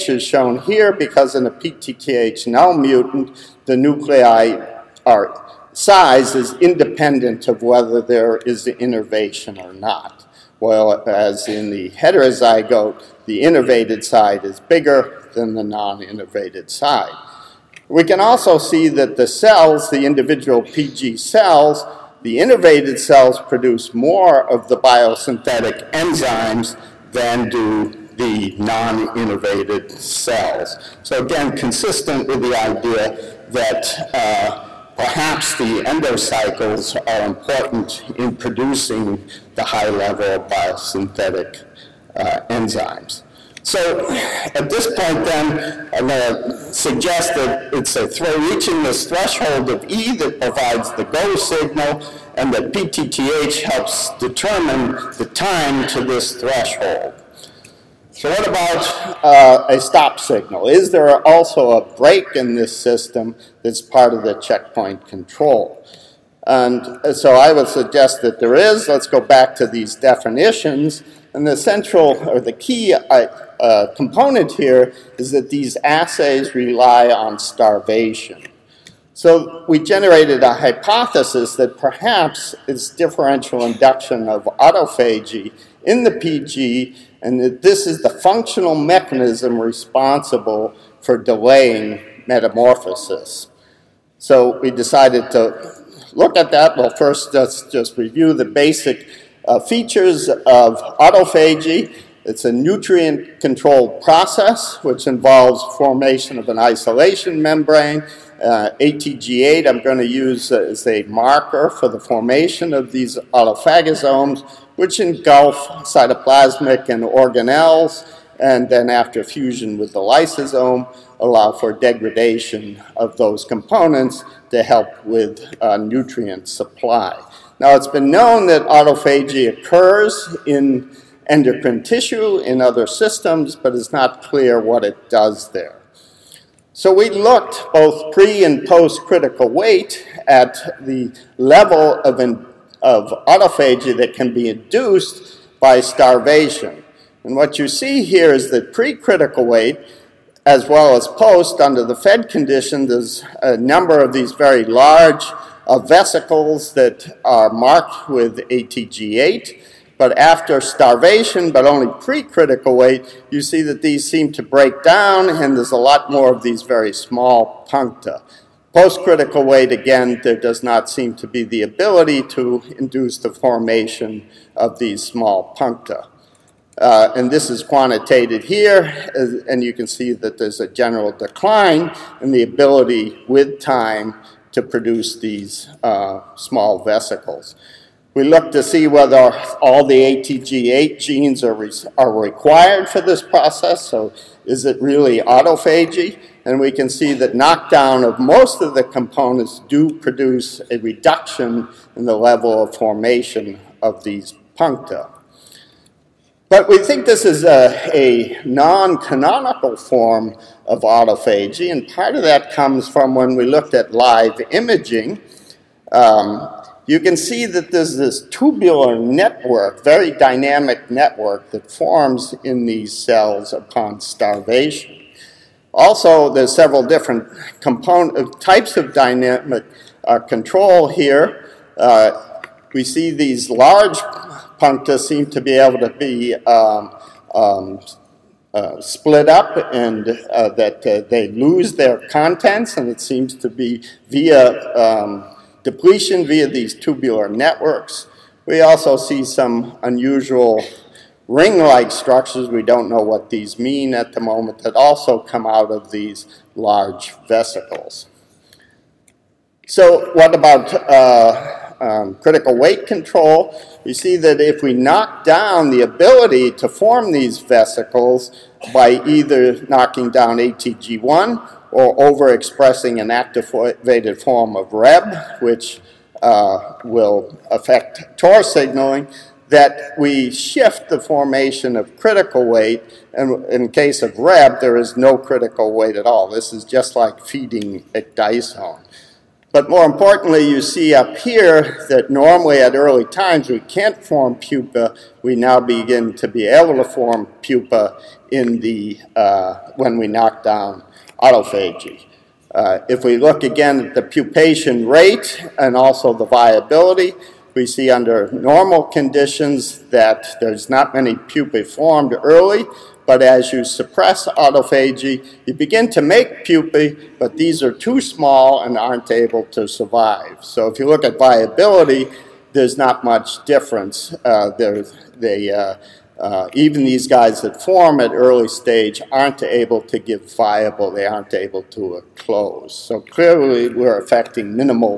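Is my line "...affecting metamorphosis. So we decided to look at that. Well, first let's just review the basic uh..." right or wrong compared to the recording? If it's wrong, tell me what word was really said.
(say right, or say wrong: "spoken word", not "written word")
wrong: "delaying", not "affecting".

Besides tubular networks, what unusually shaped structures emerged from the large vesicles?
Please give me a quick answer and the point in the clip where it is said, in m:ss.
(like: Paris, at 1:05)
Ring-like structures, at 4:11.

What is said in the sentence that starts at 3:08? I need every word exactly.
We look to see whether all the ATG8 genes are, re are required for this process, so is it really autophagy?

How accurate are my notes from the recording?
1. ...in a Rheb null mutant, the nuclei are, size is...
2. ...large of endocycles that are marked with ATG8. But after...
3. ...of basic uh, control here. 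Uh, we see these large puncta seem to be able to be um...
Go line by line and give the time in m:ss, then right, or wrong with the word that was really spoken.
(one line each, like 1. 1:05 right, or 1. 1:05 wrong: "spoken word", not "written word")
1. 0:01 wrong: "PTTH", not "Rheb"
2. 2:34 wrong: "vesicles", not "endocycles"
3. 3:48 wrong: "dynamic", not "basic".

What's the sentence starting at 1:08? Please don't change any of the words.
Let's go back to these definitions.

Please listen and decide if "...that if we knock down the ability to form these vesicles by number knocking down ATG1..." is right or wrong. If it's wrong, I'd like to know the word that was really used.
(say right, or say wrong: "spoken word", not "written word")
wrong: "either", not "number".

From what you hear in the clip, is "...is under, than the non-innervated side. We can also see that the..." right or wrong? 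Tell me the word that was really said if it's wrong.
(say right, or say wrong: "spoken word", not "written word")
wrong: "bigger", not "under".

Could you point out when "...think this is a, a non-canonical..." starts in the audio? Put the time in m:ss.
3:26.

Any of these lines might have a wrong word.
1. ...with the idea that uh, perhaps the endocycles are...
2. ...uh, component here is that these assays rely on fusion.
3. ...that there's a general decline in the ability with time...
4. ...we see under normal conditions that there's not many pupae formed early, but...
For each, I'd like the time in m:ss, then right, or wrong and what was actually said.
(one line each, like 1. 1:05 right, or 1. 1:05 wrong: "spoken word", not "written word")
1. 0:32 right
2. 1:13 wrong: "starvation", not "fusion"
3. 3:00 right
4. 5:07 right.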